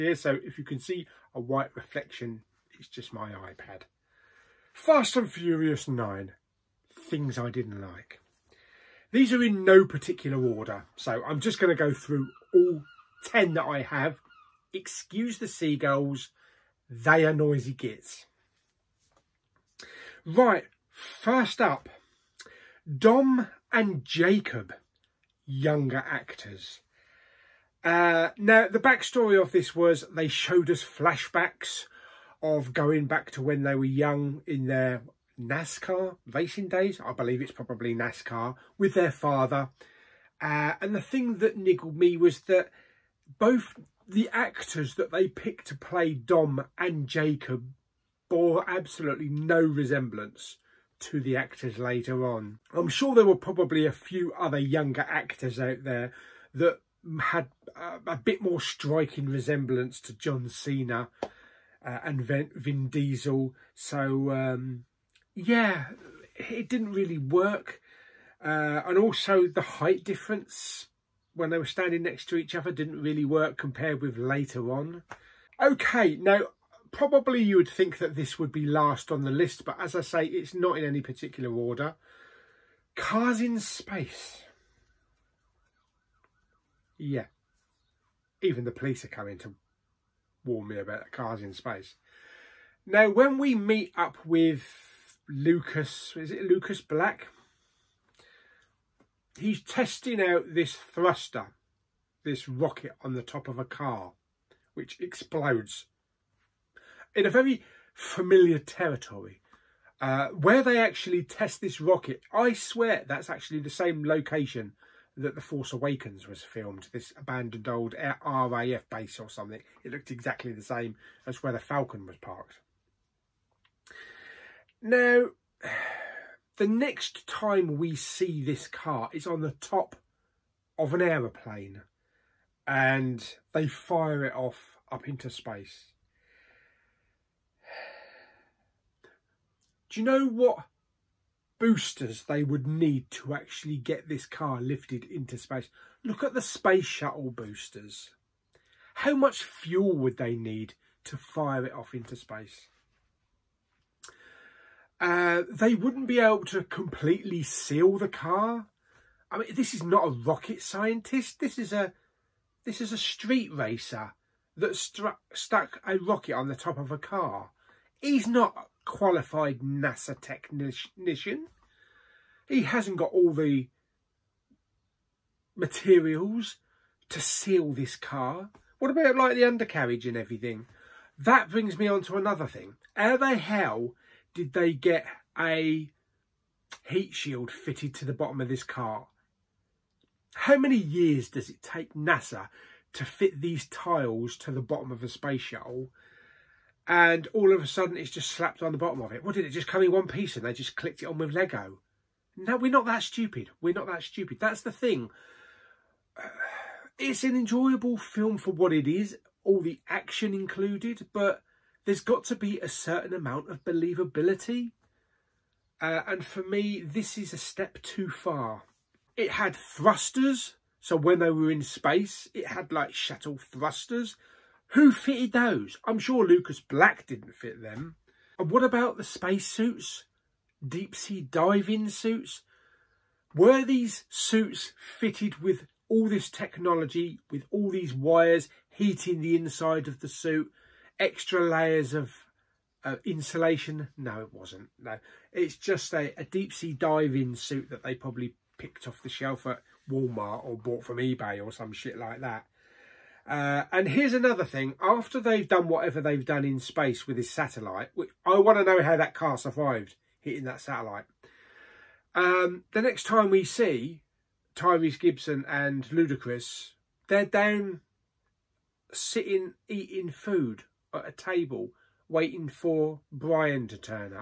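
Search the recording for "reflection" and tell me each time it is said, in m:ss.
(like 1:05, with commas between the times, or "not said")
0:01.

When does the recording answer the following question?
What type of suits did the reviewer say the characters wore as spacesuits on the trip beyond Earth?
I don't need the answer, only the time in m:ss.
3:50.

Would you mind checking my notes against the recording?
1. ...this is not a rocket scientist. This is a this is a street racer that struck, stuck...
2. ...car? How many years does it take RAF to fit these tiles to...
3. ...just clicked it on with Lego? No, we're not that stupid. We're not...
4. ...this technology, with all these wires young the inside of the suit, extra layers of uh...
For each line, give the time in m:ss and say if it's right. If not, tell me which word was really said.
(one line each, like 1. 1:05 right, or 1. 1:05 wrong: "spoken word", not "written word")
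1. 2:39 right
2. 3:08 wrong: "NASA", not "RAF"
3. 3:20 right
4. 3:56 wrong: "heating", not "young".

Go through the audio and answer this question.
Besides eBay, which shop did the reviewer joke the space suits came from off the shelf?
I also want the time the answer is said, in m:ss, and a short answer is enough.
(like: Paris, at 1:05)
Walmart, at 4:09.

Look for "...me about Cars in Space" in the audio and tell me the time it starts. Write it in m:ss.
1:30.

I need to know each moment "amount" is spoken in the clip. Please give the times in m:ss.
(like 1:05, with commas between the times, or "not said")
3:33.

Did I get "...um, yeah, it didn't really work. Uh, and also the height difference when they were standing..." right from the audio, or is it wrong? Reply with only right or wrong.
right.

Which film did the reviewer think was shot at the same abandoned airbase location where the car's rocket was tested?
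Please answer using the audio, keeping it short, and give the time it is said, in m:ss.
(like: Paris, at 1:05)
The Force Awakens, at 1:55.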